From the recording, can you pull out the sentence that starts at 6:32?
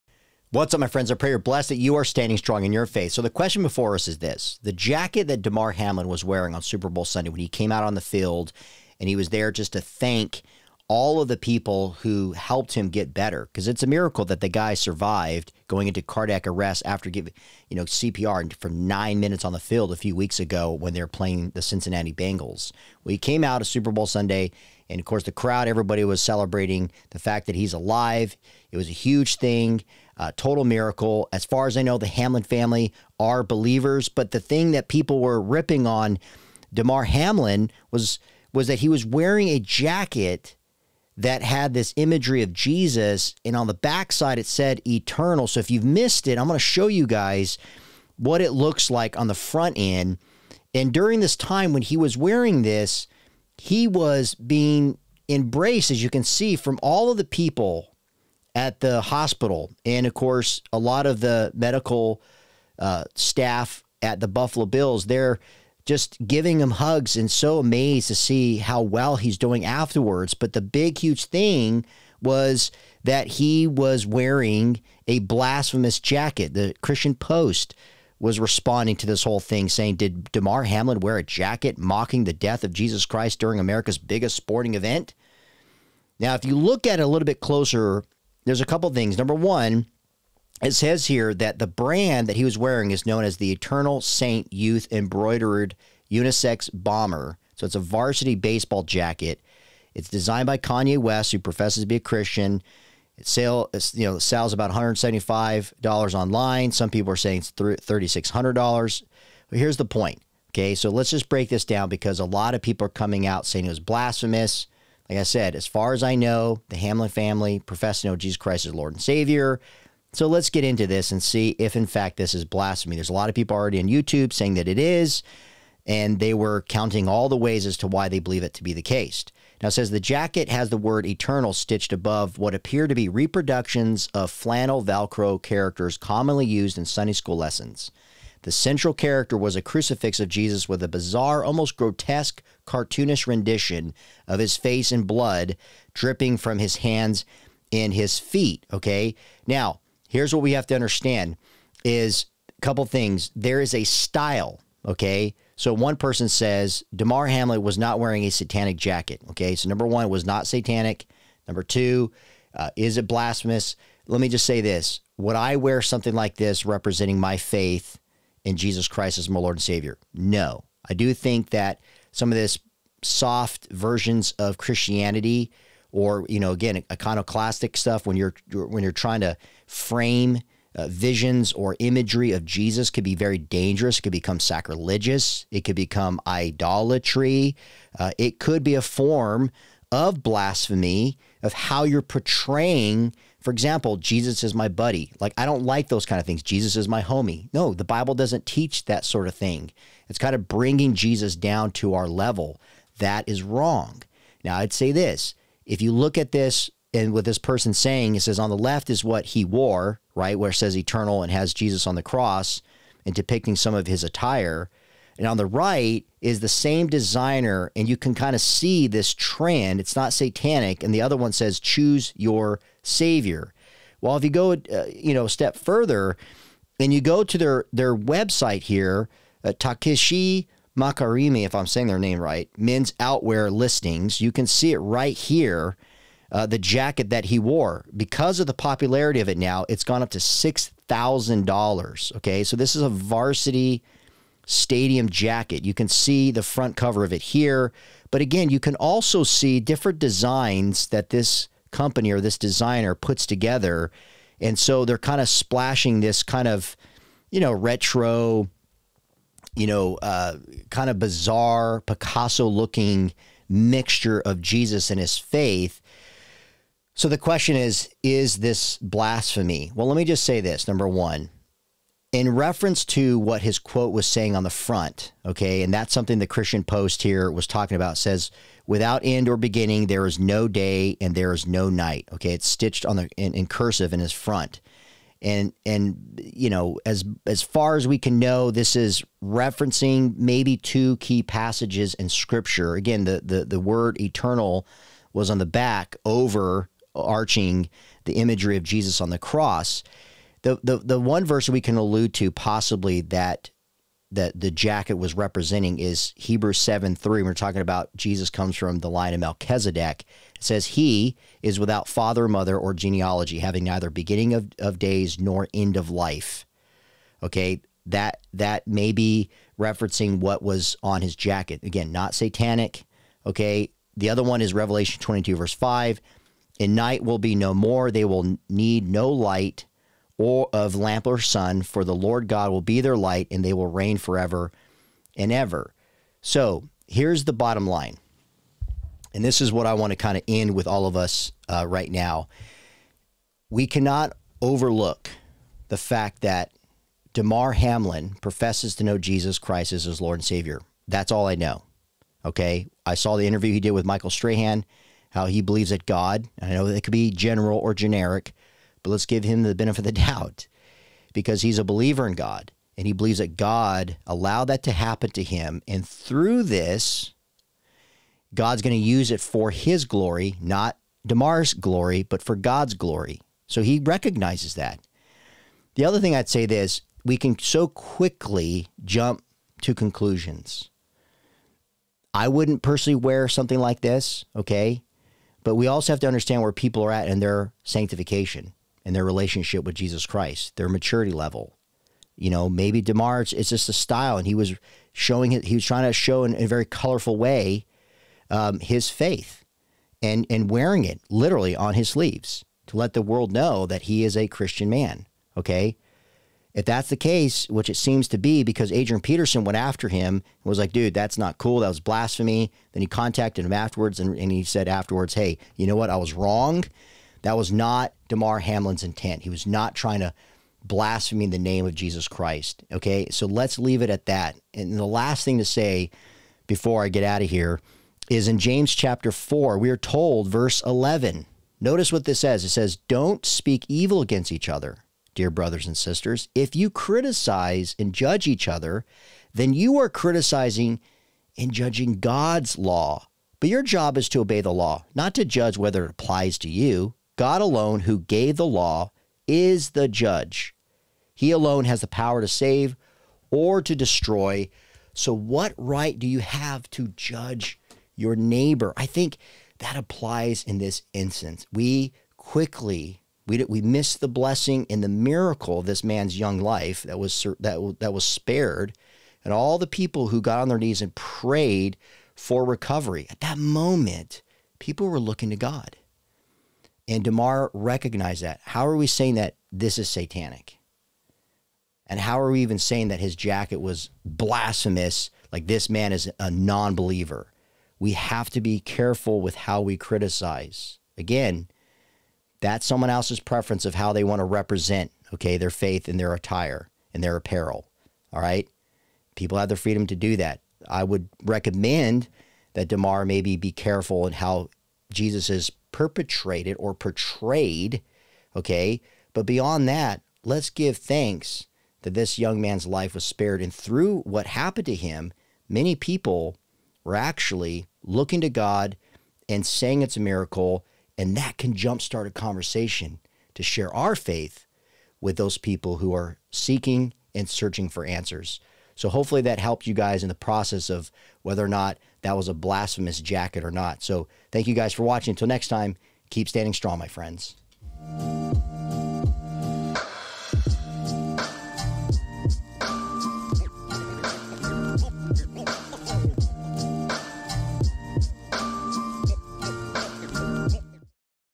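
You know, maybe Damar it's, it's just the style, and he was showing it.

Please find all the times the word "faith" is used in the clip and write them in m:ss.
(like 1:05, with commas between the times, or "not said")
0:02, 2:47, 4:25, 6:38, 8:15, 8:43.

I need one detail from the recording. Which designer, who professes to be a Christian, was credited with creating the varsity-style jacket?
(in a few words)
Kanye West.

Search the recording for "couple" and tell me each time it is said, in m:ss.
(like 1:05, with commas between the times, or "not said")
1:28, 2:32.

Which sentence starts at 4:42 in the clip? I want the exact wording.
Okay, it's stitched on the in, in cursive in his front.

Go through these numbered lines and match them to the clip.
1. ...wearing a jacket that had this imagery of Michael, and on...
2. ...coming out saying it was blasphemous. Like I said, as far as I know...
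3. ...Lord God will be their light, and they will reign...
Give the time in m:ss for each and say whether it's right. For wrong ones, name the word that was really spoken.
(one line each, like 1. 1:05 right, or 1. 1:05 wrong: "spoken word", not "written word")
1. 0:39 wrong: "Jesus", not "Michael"
2. 1:52 right
3. 5:31 right.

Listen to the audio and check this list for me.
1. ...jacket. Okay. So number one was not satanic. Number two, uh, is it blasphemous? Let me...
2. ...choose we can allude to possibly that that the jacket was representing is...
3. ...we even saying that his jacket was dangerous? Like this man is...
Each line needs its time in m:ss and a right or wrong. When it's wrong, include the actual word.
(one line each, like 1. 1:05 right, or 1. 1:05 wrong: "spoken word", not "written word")
1. 2:38 right
2. 5:01 wrong: "verse", not "choose"
3. 8:02 wrong: "blasphemous", not "dangerous".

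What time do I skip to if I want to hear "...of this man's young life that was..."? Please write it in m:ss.
7:45.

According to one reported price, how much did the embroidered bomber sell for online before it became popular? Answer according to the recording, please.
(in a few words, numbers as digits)
$175.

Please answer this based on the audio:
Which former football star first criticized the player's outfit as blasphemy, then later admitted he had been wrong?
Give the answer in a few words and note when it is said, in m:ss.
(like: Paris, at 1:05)
Adrian Peterson, at 6:48.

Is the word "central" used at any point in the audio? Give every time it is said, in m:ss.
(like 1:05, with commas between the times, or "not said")
2:18.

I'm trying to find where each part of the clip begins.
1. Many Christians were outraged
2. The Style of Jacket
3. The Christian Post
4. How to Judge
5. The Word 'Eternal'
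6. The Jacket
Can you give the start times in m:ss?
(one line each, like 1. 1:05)
1. 0:34
2. 2:30
3. 1:15
4. 5:45
5. 4:45
6. 0:51.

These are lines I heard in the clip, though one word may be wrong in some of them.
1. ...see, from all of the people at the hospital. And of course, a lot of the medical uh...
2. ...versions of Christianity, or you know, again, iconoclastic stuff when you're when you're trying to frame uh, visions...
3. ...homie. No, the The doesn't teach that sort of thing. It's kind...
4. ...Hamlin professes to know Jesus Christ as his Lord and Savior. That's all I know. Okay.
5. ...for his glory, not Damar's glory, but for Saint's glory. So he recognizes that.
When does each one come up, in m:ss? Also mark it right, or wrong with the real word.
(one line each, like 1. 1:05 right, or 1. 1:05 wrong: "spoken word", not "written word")
1. 0:56 right
2. 2:53 right
3. 3:17 wrong: "Bible", not "The"
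4. 5:47 right
5. 6:09 wrong: "God", not "Saint".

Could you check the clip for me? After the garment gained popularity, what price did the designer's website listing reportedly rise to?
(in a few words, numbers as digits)
$6,000.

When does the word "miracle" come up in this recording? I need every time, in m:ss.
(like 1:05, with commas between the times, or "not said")
0:13, 0:30, 7:44, 8:40.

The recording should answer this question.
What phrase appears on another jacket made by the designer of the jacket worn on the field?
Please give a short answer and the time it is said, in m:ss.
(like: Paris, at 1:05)
Choose your savior, at 3:41.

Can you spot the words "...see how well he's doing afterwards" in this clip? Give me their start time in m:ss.
1:08.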